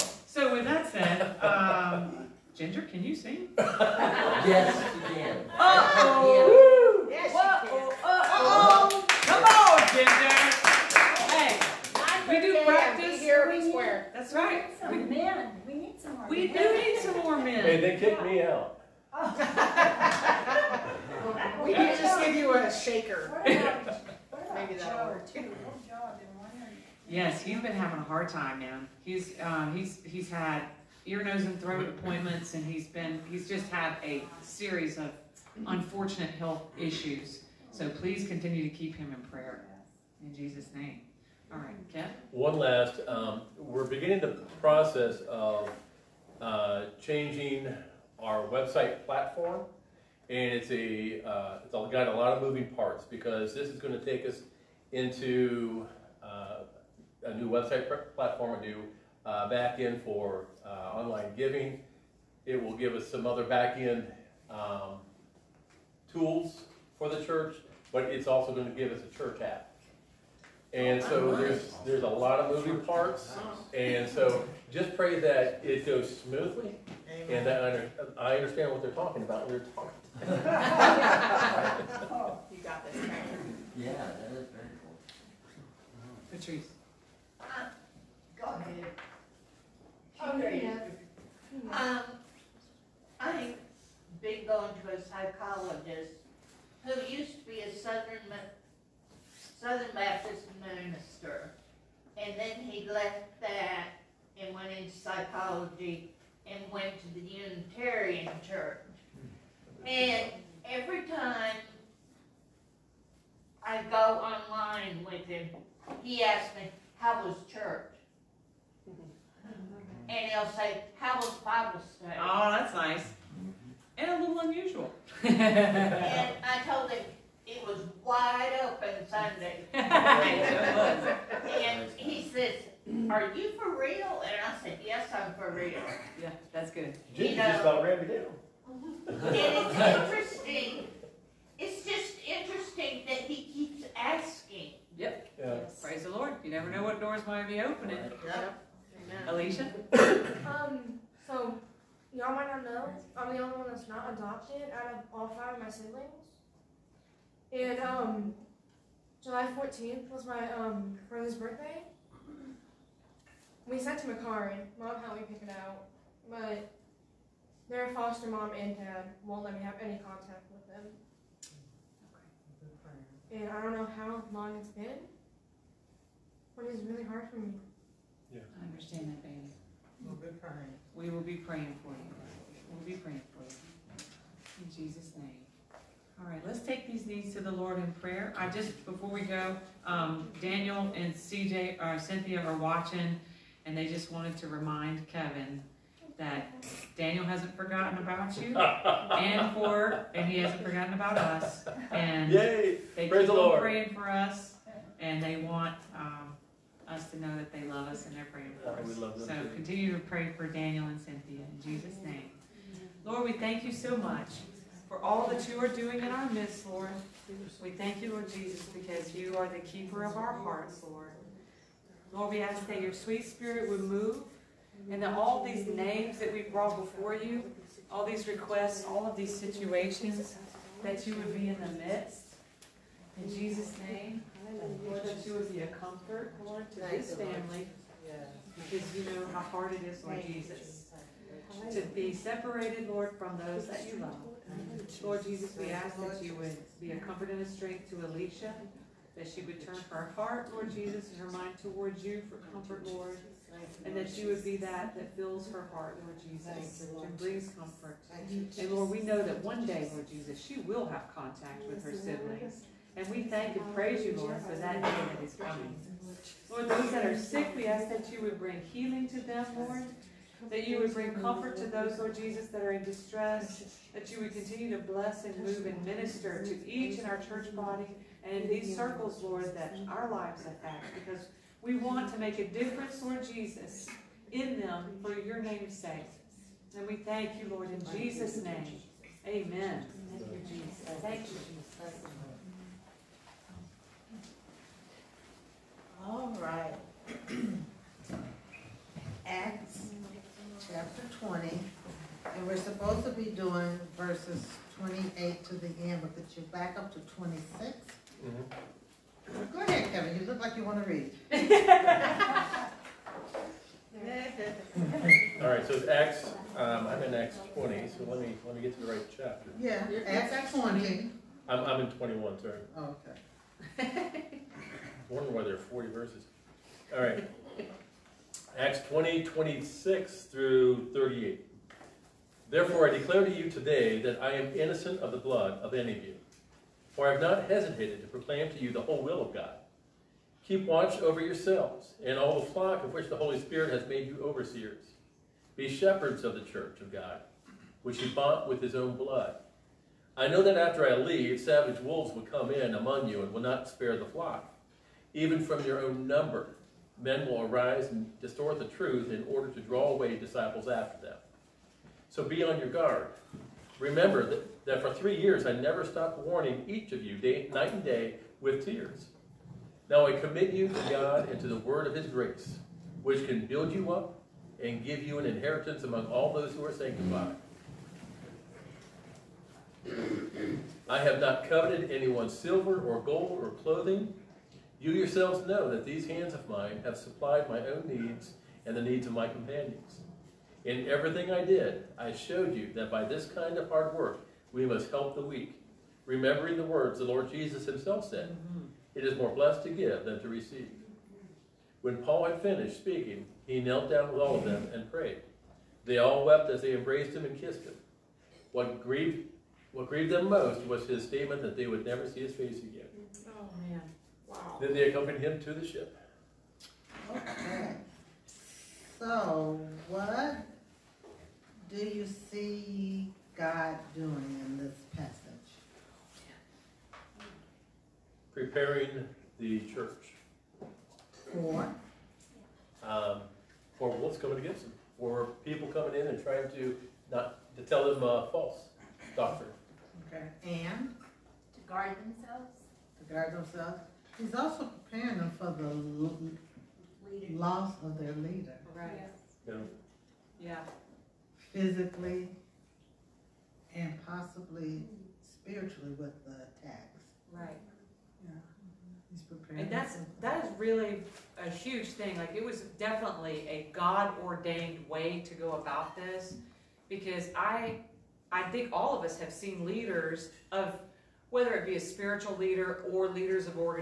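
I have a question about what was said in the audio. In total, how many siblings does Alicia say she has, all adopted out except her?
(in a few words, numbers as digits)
5.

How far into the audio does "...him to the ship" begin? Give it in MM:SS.
06:55.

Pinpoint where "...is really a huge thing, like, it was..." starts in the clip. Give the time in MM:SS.
07:40.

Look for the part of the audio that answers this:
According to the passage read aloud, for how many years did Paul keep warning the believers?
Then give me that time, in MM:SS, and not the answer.
06:04.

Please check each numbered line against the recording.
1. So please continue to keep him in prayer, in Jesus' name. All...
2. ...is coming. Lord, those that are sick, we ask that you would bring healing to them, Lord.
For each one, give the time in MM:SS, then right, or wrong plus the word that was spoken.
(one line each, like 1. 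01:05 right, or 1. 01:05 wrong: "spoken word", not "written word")
1. 00:37 right
2. 04:25 right.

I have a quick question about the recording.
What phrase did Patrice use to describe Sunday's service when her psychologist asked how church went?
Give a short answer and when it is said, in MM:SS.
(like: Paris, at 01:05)
wide open Sunday, at 02:08.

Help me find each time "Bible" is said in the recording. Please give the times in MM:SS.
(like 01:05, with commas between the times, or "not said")
02:01.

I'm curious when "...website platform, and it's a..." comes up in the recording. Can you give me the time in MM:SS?
00:48.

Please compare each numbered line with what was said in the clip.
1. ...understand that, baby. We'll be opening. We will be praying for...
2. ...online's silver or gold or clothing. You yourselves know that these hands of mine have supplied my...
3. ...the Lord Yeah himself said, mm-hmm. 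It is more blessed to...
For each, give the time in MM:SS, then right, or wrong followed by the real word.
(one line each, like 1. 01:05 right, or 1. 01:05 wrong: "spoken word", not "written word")
1. 02:58 wrong: "praying", not "opening"
2. 06:21 wrong: "anyone", not "online"
3. 06:36 wrong: "Jesus", not "Yeah".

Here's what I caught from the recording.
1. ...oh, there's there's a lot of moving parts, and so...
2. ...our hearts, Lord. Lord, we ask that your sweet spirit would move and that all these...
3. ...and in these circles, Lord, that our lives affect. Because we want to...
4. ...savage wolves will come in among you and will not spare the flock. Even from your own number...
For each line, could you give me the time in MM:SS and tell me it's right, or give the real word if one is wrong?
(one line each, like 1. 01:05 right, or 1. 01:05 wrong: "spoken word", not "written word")
1. 01:11 right
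2. 03:40 right
3. 04:38 right
4. 05:51 right.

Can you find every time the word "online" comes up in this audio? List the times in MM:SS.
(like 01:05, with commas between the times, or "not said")
01:00, 01:54.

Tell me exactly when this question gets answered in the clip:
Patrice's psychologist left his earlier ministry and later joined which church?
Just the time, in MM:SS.
01:47.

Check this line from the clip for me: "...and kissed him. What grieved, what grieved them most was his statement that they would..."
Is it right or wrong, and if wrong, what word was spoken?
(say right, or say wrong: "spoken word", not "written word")
right.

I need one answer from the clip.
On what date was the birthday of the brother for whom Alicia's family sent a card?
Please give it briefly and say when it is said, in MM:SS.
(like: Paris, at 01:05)
July 14th, at 02:39.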